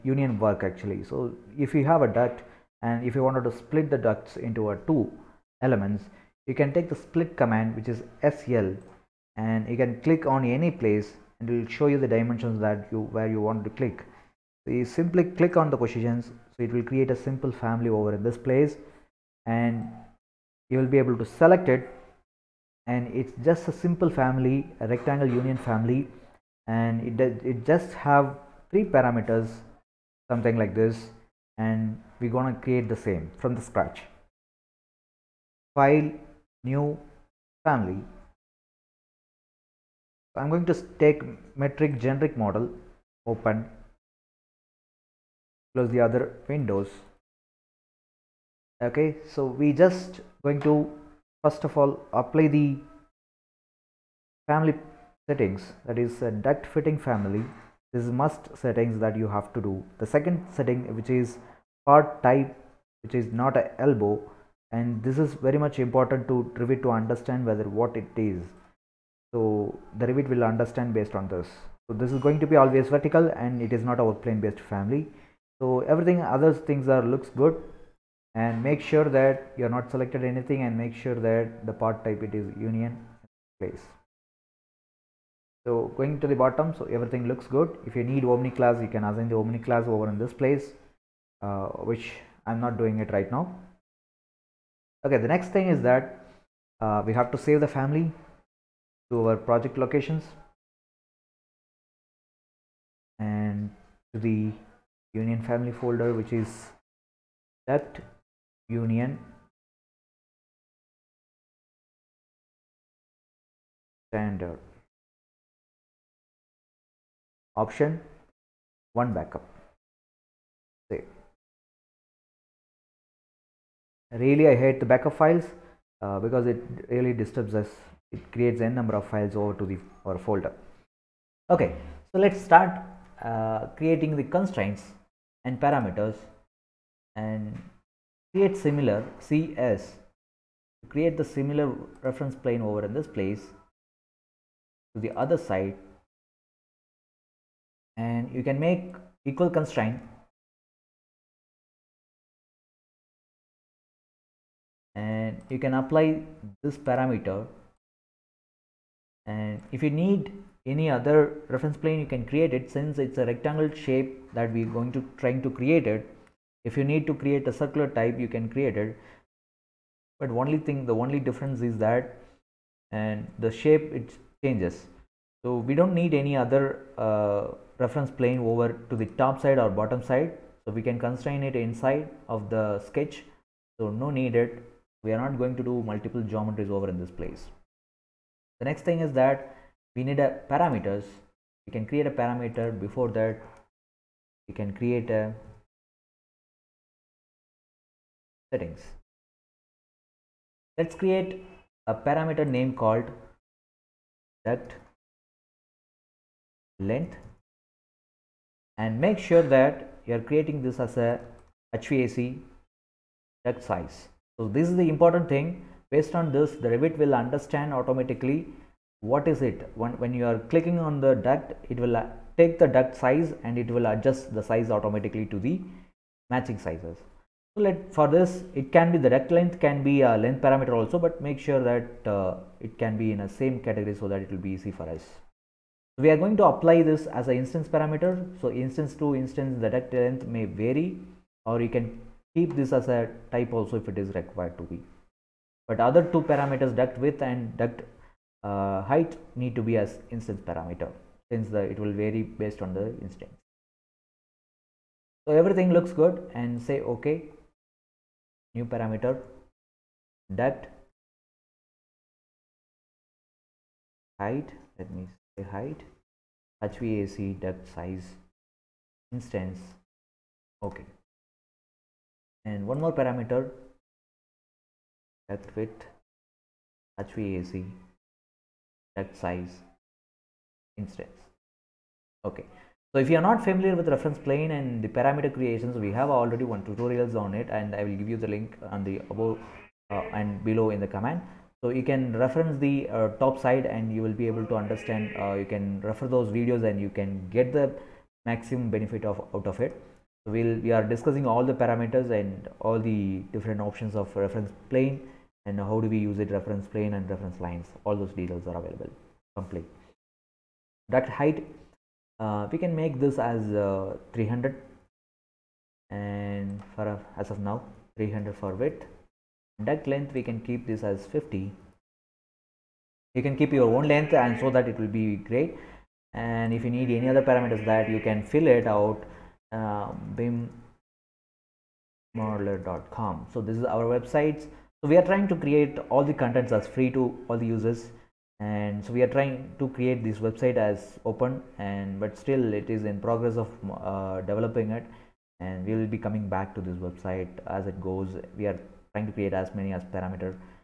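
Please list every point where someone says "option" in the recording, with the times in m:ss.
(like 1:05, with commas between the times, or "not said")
1:57, 5:03.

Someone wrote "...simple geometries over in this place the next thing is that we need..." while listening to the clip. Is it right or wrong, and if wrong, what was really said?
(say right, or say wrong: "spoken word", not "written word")
wrong: "multiple", not "simple".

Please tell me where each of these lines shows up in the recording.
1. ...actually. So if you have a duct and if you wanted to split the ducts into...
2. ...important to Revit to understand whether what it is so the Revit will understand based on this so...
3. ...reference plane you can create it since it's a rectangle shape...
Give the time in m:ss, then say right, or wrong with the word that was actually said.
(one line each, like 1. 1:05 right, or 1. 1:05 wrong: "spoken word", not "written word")
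1. 0:00 right
2. 1:05 right
3. 2:41 right.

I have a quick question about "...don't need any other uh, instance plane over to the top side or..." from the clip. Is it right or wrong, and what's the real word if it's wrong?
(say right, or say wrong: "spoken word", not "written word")
wrong: "reference", not "instance".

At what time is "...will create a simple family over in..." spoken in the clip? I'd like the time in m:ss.
0:16.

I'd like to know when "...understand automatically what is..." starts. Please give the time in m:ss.
3:37.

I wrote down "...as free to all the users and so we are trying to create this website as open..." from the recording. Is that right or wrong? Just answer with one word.
right.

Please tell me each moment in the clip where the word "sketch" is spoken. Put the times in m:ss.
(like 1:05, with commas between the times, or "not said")
3:02.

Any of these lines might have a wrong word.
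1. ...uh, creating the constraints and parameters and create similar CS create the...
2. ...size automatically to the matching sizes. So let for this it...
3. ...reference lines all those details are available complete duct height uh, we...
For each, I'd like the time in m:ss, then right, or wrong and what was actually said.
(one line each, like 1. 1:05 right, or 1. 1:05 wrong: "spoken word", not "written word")
1. 2:13 right
2. 3:44 right
3. 5:07 right.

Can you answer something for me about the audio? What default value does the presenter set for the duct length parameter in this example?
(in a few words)
50.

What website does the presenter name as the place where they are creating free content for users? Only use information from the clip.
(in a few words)
bimmodeler.com.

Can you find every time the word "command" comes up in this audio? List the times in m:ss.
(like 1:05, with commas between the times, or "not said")
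0:07, 4:50.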